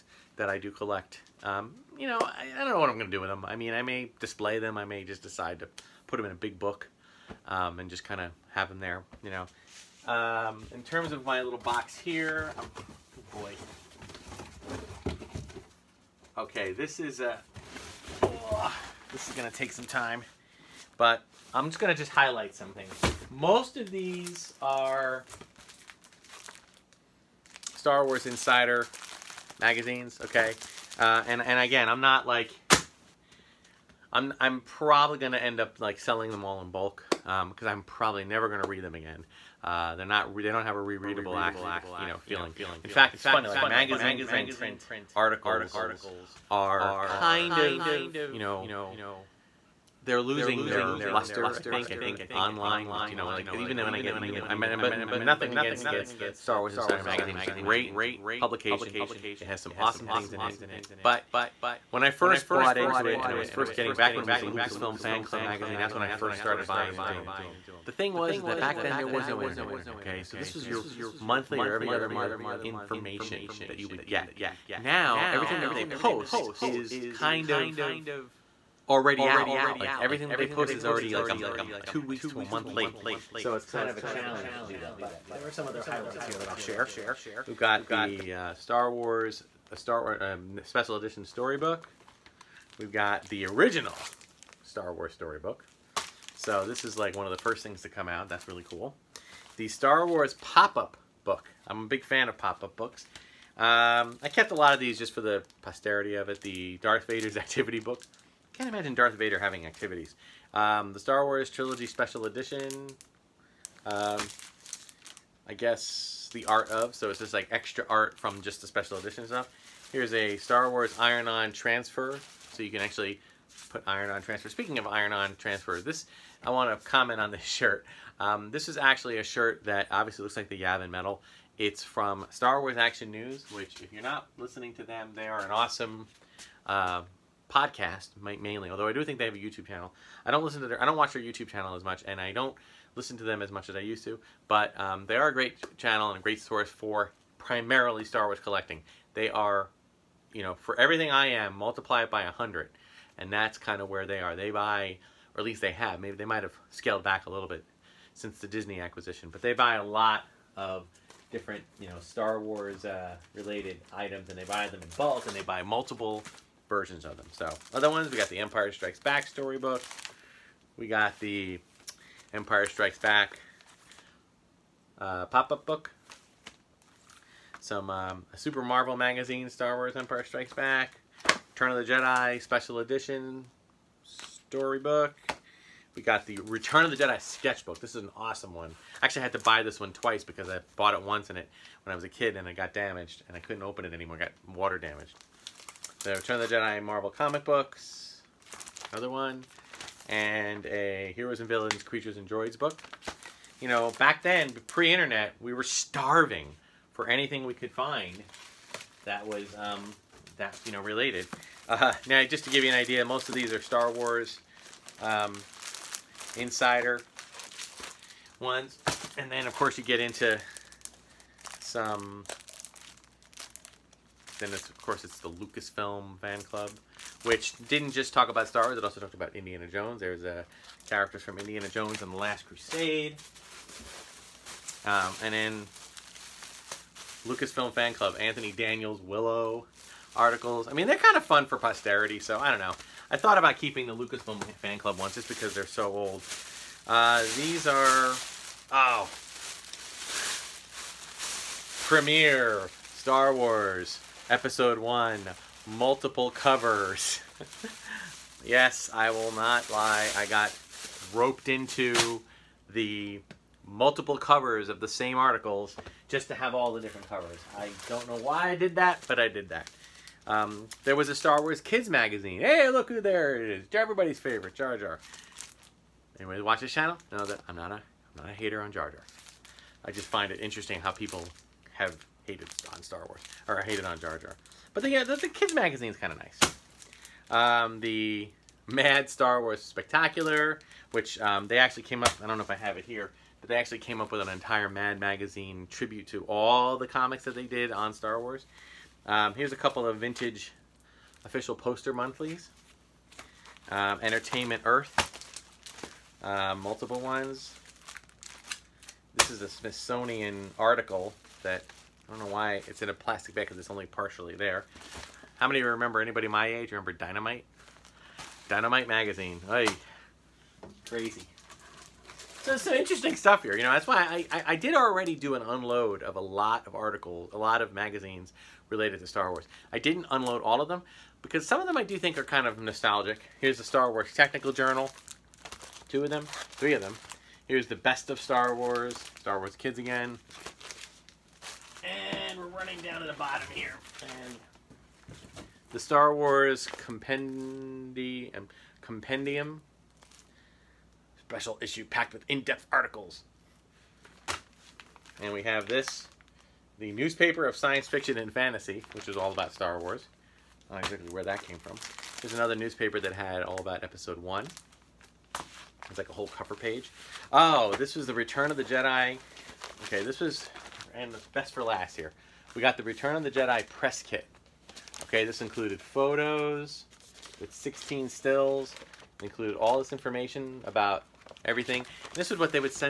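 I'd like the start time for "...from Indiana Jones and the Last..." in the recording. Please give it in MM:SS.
03:51.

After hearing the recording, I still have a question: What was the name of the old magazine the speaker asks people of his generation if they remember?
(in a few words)
Dynamite.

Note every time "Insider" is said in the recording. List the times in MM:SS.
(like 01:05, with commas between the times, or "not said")
00:28, 00:56, 03:36.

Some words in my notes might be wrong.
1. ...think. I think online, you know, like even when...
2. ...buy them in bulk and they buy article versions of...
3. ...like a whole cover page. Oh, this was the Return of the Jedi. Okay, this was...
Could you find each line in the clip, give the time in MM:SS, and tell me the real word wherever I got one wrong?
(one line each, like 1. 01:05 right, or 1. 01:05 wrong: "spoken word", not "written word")
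1. 00:51 right
2. 02:44 wrong: "multiple", not "article"
3. 06:05 right.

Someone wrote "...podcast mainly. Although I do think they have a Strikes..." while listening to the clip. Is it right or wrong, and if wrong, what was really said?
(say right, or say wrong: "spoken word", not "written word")
wrong: "YouTube", not "Strikes".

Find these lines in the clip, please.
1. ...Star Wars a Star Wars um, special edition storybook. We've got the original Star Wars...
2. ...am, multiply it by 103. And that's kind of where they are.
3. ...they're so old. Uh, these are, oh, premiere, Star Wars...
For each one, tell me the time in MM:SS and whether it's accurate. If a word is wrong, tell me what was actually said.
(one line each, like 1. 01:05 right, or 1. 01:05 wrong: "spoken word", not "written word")
1. 01:28 right
2. 02:31 wrong: "100", not "103"
3. 04:05 right.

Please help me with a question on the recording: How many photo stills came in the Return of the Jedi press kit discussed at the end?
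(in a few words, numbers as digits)
16.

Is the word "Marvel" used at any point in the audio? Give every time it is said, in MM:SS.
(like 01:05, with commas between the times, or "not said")
02:58, 03:16.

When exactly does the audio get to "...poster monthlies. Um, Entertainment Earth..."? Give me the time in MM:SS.
05:01.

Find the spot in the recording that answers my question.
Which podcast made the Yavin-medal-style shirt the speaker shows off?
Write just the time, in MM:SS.
02:12.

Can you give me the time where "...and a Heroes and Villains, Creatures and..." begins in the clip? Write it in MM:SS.
03:20.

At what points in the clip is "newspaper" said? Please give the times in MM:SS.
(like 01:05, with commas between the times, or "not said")
05:56, 06:02.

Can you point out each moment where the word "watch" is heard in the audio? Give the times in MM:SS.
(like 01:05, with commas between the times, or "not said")
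02:20, 04:36.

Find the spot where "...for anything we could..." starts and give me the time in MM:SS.
03:27.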